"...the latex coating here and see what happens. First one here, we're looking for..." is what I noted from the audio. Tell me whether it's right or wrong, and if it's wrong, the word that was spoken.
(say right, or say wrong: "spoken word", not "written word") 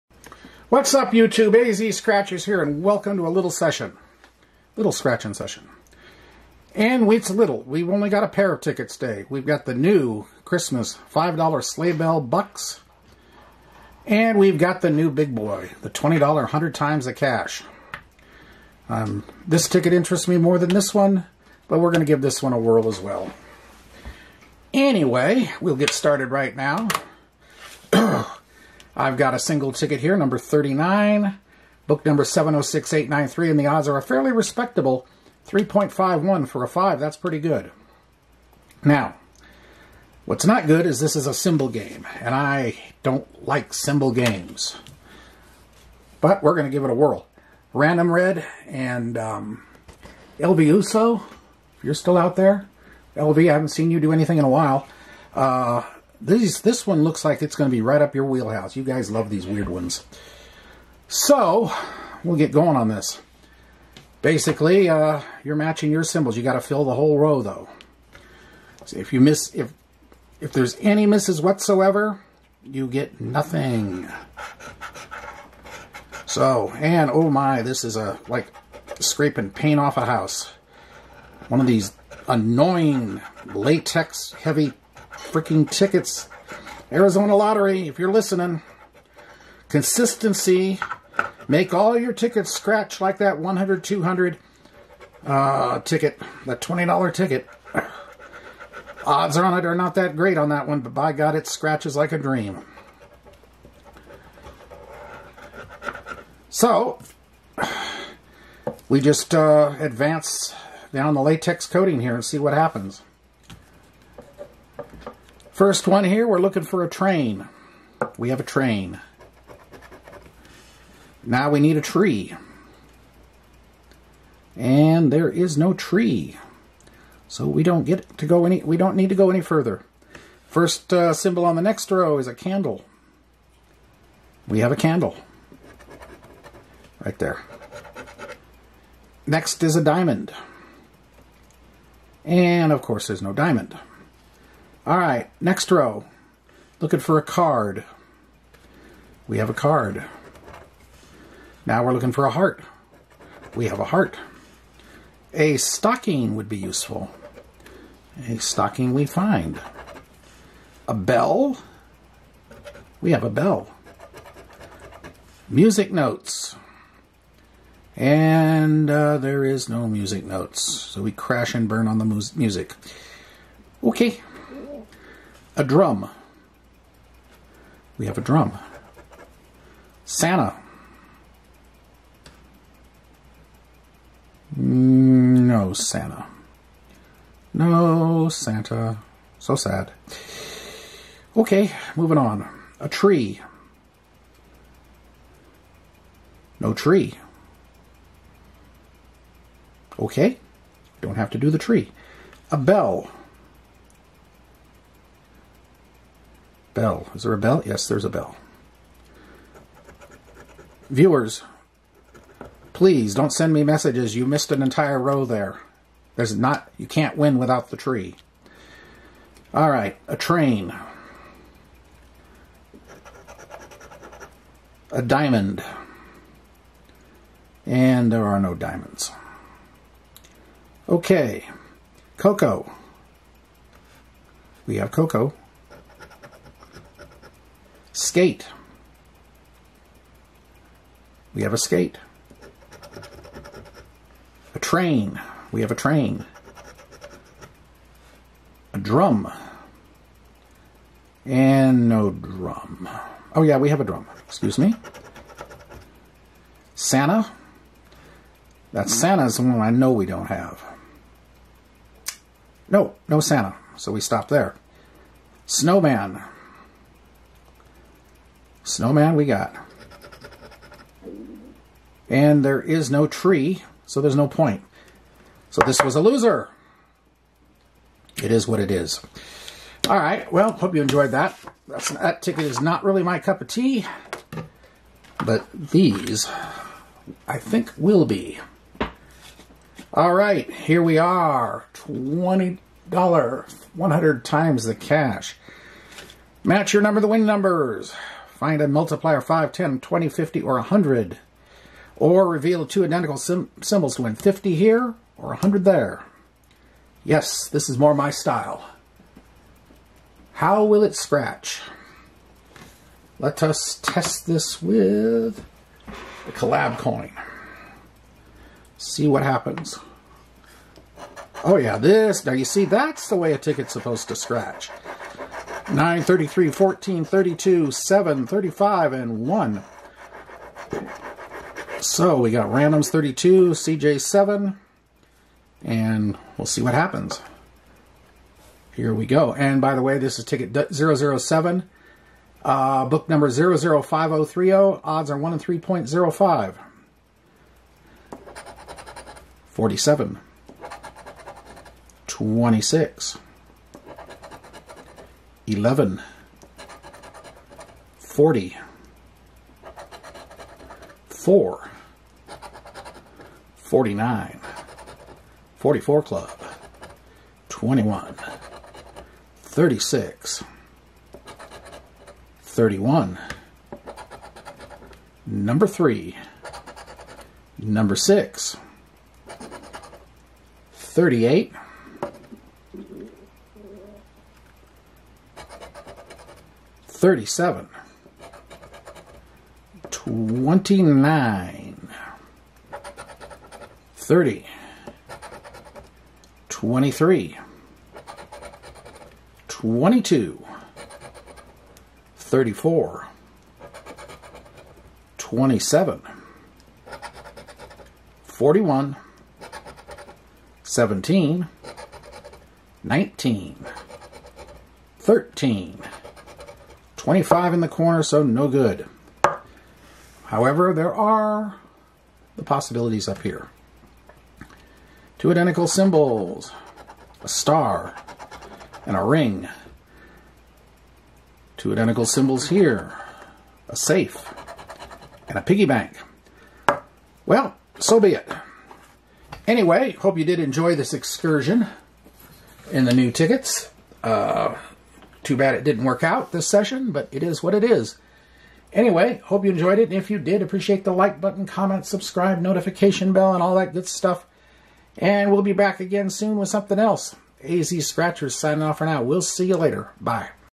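right.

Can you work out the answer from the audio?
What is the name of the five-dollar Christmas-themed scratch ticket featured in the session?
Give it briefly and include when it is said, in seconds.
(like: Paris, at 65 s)
Sleigh Bell Bucks, at 11 s.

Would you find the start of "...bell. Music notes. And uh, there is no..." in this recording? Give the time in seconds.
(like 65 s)
163 s.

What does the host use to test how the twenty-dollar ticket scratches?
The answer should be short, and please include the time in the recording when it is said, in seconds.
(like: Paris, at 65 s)
Collab coin, at 316 s.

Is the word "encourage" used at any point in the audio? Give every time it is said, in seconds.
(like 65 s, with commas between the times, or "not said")
not said.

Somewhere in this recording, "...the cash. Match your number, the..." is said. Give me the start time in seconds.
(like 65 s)
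294 s.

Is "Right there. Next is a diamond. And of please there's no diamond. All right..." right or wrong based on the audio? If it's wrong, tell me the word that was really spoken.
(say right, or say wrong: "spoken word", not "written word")
wrong: "course", not "please".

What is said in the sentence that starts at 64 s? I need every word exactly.
Basically, uh, you're matching your symbols.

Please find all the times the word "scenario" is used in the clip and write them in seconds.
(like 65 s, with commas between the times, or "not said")
not said.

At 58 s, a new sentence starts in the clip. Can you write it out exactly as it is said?
You guys love these weird ones.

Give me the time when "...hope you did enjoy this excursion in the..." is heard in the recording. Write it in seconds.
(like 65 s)
439 s.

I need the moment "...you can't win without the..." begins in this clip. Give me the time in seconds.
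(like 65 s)
216 s.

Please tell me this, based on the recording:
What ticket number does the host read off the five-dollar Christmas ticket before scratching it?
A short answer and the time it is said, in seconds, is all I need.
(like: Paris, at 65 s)
39, at 30 s.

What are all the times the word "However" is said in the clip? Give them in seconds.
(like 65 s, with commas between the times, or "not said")
420 s.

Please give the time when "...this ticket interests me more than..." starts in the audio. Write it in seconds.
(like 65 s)
19 s.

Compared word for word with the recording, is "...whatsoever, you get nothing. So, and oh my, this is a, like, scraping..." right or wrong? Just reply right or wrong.
right.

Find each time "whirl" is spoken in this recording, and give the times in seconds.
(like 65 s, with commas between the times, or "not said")
22 s, 46 s.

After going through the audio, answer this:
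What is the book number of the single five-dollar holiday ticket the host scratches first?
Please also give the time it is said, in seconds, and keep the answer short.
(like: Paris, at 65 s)
706893, at 32 s.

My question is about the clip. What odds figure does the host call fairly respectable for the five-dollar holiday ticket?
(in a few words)
3.51.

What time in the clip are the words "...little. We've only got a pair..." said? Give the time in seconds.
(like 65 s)
7 s.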